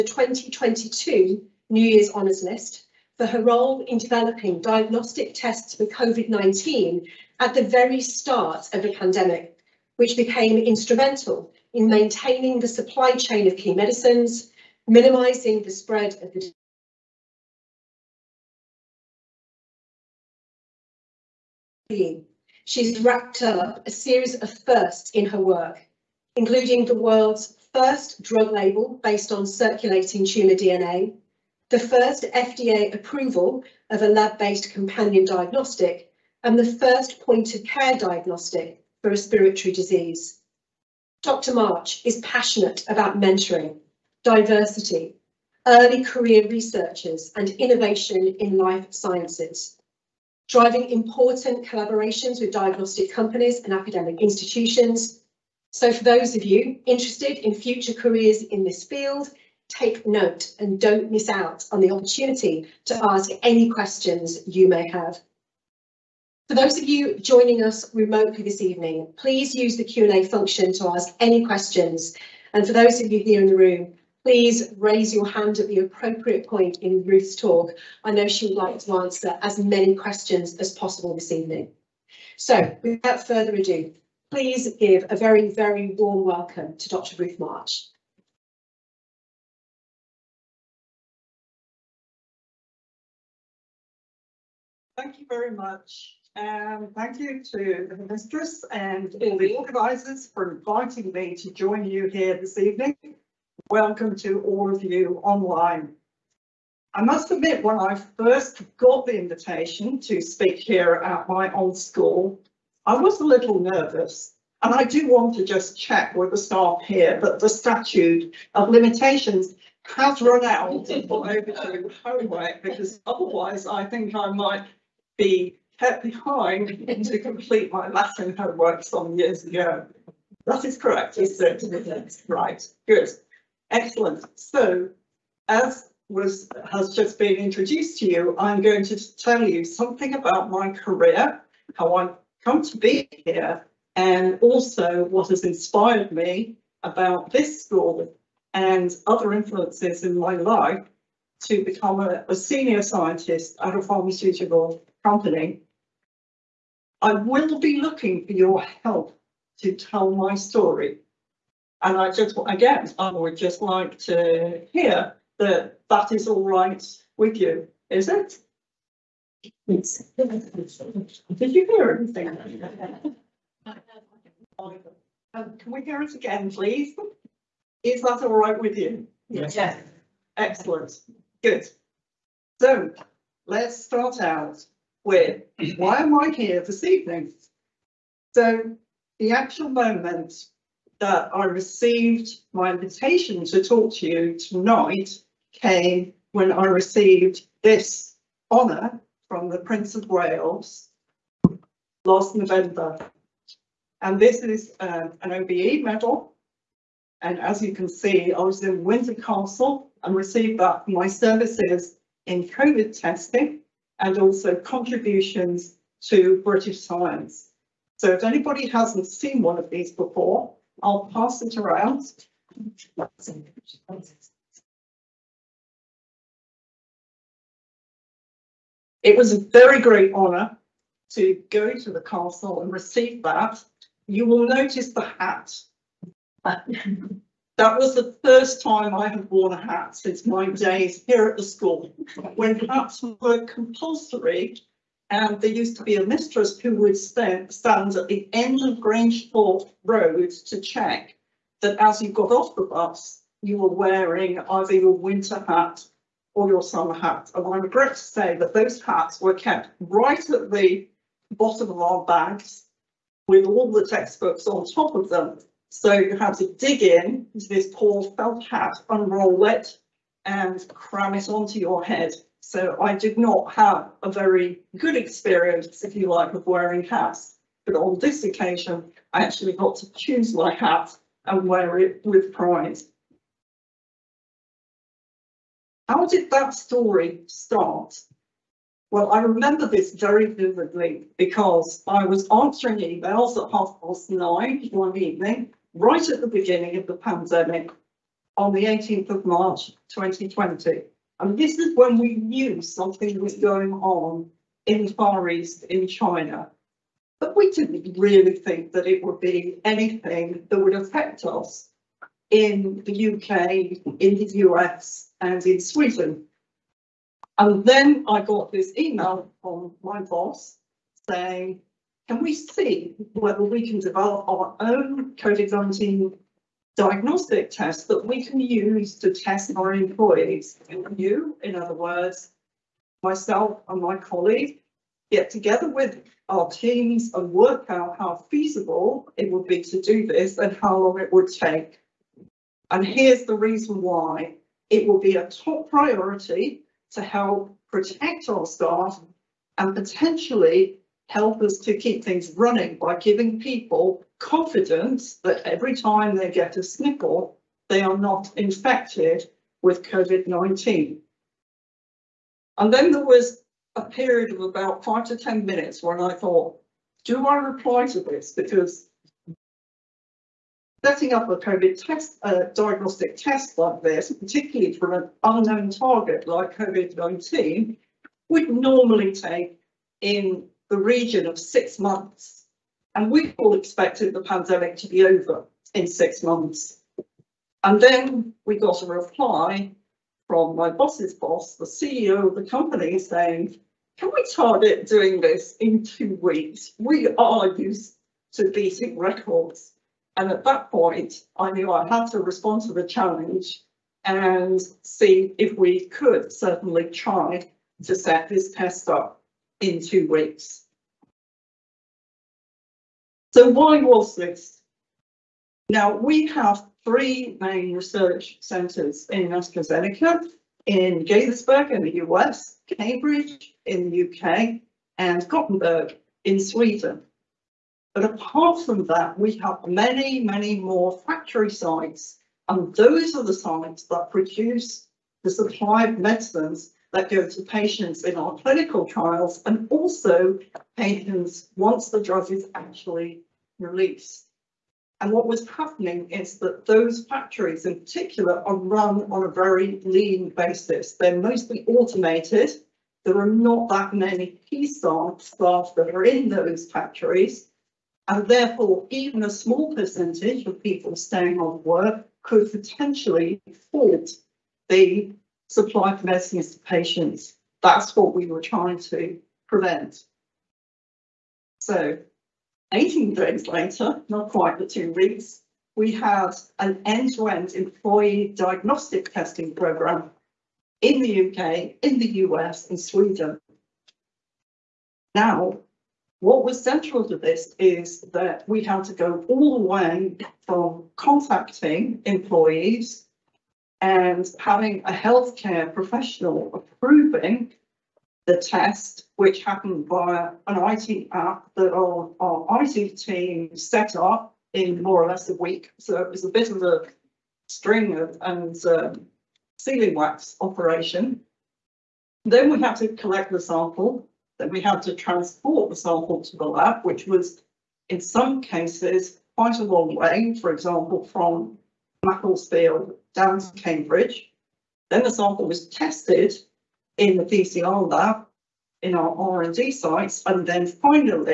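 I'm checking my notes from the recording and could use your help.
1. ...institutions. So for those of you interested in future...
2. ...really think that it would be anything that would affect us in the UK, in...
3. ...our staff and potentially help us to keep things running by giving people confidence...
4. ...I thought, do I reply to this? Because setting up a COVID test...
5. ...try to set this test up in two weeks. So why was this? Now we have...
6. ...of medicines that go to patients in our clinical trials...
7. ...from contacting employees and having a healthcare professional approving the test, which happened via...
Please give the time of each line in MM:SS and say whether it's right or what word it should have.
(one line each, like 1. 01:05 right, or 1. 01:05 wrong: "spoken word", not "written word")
1. 00:54 right
2. 05:07 right
3. 05:48 right
4. 06:05 right
5. 06:46 right
6. 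07:15 right
7. 08:10 right.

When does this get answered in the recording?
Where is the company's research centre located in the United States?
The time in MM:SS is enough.
07:01.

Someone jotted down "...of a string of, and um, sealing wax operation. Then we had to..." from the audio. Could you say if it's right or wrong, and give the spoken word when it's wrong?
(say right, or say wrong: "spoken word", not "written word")
right.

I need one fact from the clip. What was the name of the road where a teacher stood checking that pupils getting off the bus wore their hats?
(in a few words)
Grangethorpe Road.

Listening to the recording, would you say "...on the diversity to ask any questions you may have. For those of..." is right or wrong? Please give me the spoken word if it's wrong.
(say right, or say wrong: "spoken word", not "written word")
wrong: "opportunity", not "diversity".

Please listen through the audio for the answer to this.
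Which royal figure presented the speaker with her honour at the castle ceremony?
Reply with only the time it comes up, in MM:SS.
03:19.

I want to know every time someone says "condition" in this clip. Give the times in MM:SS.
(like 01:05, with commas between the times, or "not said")
not said.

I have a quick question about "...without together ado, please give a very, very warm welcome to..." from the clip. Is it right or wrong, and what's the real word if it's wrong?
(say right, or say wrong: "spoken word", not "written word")
wrong: "further", not "together".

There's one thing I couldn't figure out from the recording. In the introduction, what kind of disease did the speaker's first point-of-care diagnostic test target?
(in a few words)
Respiratory disease.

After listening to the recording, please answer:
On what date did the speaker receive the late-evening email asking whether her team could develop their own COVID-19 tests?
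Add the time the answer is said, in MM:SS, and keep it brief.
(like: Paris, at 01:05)
18 March 2020, at 04:58.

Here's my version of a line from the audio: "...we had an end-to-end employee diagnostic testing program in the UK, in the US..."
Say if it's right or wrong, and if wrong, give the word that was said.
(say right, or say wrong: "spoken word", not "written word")
right.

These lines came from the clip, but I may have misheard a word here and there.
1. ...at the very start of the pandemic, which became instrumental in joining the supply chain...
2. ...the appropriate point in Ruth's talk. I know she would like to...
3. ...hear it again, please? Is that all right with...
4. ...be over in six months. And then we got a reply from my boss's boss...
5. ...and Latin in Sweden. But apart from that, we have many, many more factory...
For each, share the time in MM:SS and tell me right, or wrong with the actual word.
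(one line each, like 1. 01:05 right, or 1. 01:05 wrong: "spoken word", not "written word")
1. 00:07 wrong: "maintaining", not "joining"
2. 01:15 right
3. 02:55 right
4. 06:24 right
5. 07:04 wrong: "Gothenburg", not "Latin".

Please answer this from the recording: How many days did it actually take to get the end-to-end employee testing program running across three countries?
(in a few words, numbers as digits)
18.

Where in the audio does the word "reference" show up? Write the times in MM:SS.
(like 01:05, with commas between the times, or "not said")
not said.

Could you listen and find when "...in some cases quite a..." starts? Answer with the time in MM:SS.
08:37.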